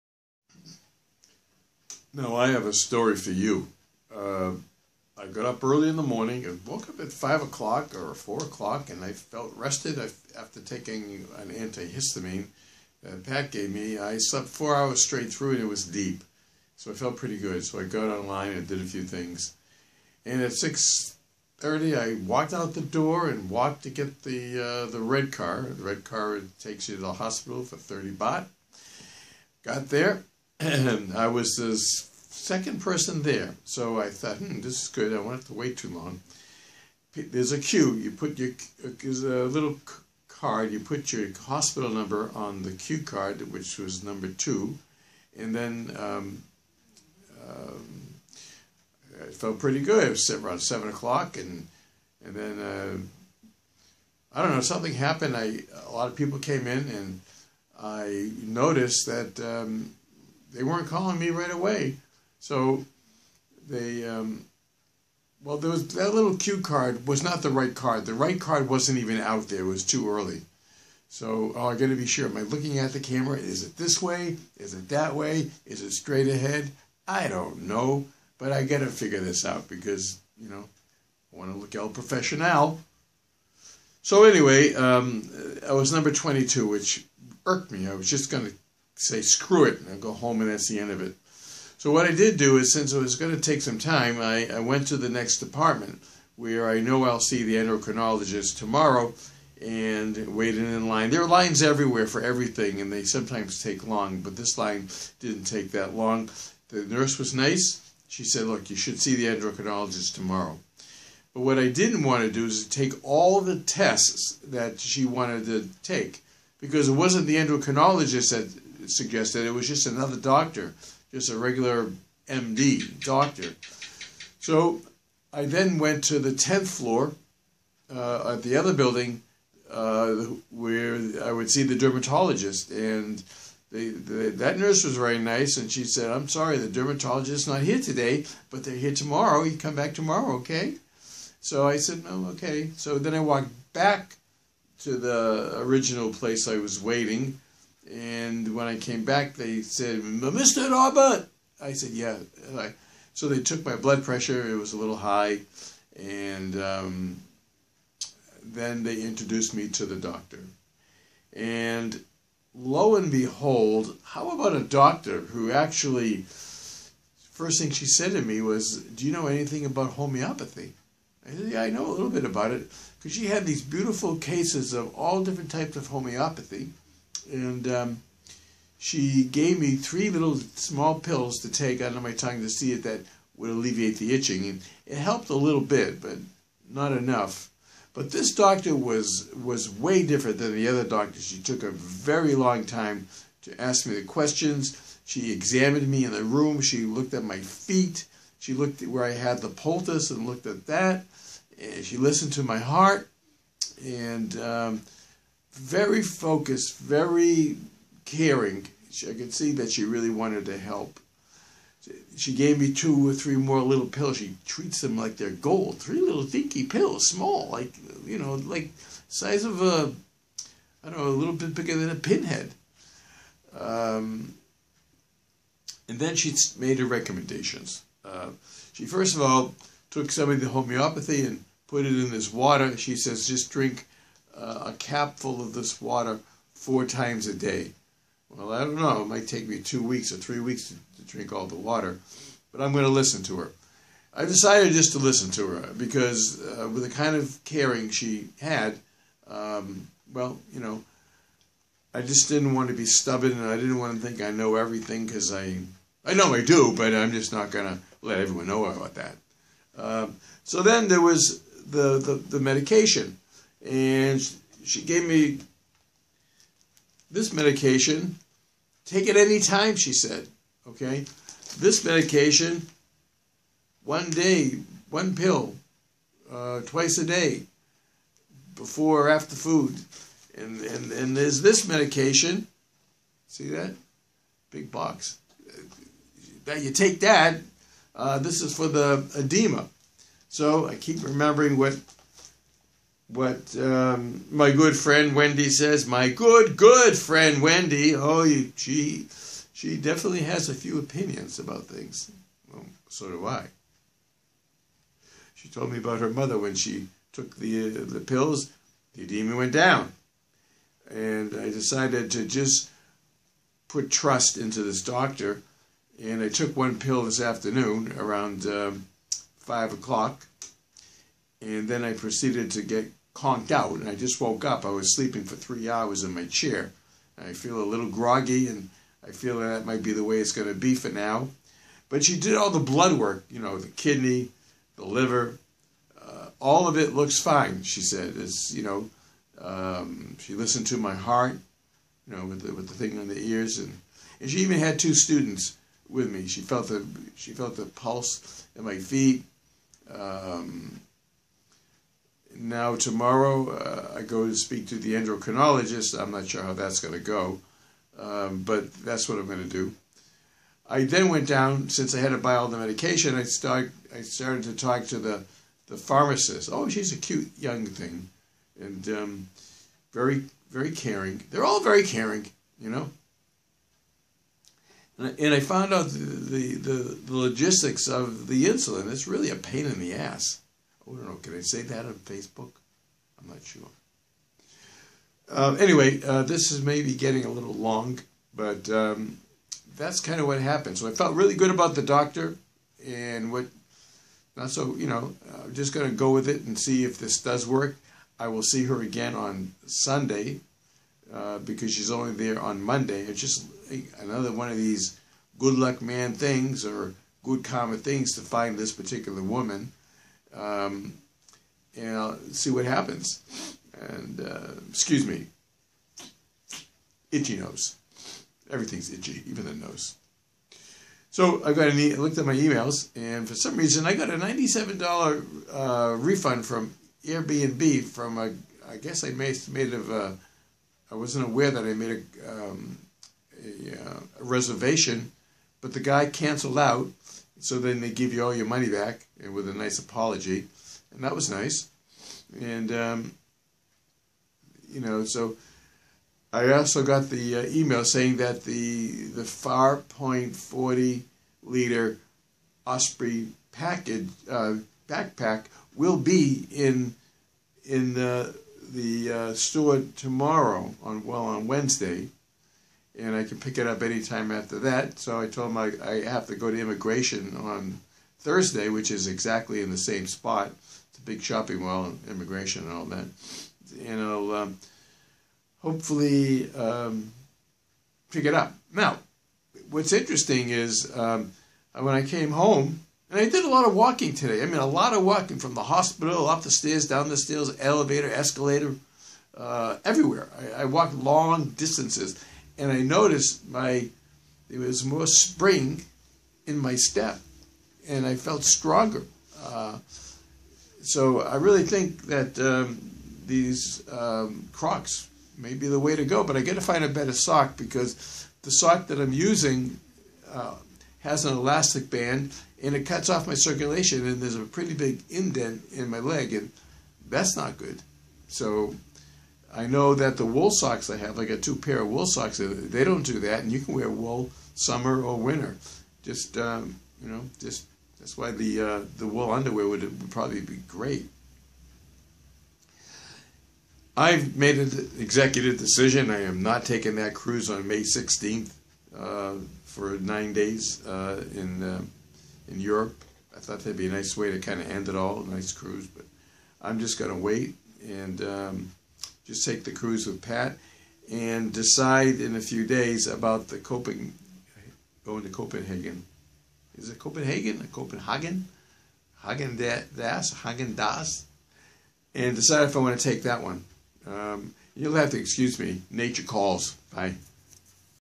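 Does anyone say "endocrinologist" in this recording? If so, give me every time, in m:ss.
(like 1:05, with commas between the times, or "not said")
1:37, 1:49, 1:57, 5:54.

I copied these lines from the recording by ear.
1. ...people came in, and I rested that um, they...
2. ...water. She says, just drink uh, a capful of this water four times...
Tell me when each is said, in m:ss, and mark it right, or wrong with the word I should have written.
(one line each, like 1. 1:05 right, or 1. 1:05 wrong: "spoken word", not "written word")
1. 0:56 wrong: "noticed", not "rested"
2. 3:52 right.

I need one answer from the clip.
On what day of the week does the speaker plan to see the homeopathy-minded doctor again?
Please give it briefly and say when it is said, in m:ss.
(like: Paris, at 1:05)
Sunday, at 6:39.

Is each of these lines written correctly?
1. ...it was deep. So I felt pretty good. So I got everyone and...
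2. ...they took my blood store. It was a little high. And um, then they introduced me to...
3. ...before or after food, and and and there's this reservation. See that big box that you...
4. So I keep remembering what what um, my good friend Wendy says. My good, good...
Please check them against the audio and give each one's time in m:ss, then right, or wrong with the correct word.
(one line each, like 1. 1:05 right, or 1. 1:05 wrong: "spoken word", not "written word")
1. 0:15 wrong: "online", not "everyone"
2. 2:33 wrong: "pressure", not "store"
3. 4:38 wrong: "medication", not "reservation"
4. 4:50 right.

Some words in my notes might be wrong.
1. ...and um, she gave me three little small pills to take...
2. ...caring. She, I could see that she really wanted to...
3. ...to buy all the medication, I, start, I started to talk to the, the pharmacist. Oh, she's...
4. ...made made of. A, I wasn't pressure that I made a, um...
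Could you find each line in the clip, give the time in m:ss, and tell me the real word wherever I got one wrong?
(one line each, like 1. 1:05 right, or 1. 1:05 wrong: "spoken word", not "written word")
1. 2:57 right
2. 3:28 right
3. 6:02 right
4. 7:09 wrong: "aware", not "pressure".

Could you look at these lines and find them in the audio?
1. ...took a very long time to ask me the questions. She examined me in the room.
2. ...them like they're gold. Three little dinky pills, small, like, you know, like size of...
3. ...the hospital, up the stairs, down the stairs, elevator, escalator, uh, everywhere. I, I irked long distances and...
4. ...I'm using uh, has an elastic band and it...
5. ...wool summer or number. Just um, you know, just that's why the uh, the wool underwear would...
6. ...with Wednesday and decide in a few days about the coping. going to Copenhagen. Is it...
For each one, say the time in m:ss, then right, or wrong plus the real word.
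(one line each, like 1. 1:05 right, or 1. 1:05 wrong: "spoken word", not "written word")
1. 3:11 right
2. 3:34 right
3. 8:05 wrong: "walked", not "irked"
4. 8:28 right
5. 8:43 wrong: "winter", not "number"
6. 9:10 wrong: "Pat", not "Wednesday".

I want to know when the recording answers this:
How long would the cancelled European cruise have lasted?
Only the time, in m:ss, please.
8:59.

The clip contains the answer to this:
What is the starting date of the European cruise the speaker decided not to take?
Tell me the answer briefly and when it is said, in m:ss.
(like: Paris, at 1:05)
May 16, at 8:57.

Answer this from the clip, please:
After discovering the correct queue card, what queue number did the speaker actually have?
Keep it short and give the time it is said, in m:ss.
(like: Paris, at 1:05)
22, at 1:25.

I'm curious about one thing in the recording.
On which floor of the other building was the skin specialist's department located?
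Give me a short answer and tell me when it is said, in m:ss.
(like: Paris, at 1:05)
10th floor, at 2:06.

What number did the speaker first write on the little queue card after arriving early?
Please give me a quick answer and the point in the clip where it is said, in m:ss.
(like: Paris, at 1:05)
2, at 0:44.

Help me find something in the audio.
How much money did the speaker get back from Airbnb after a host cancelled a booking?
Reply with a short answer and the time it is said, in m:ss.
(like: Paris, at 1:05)
$97, at 7:04.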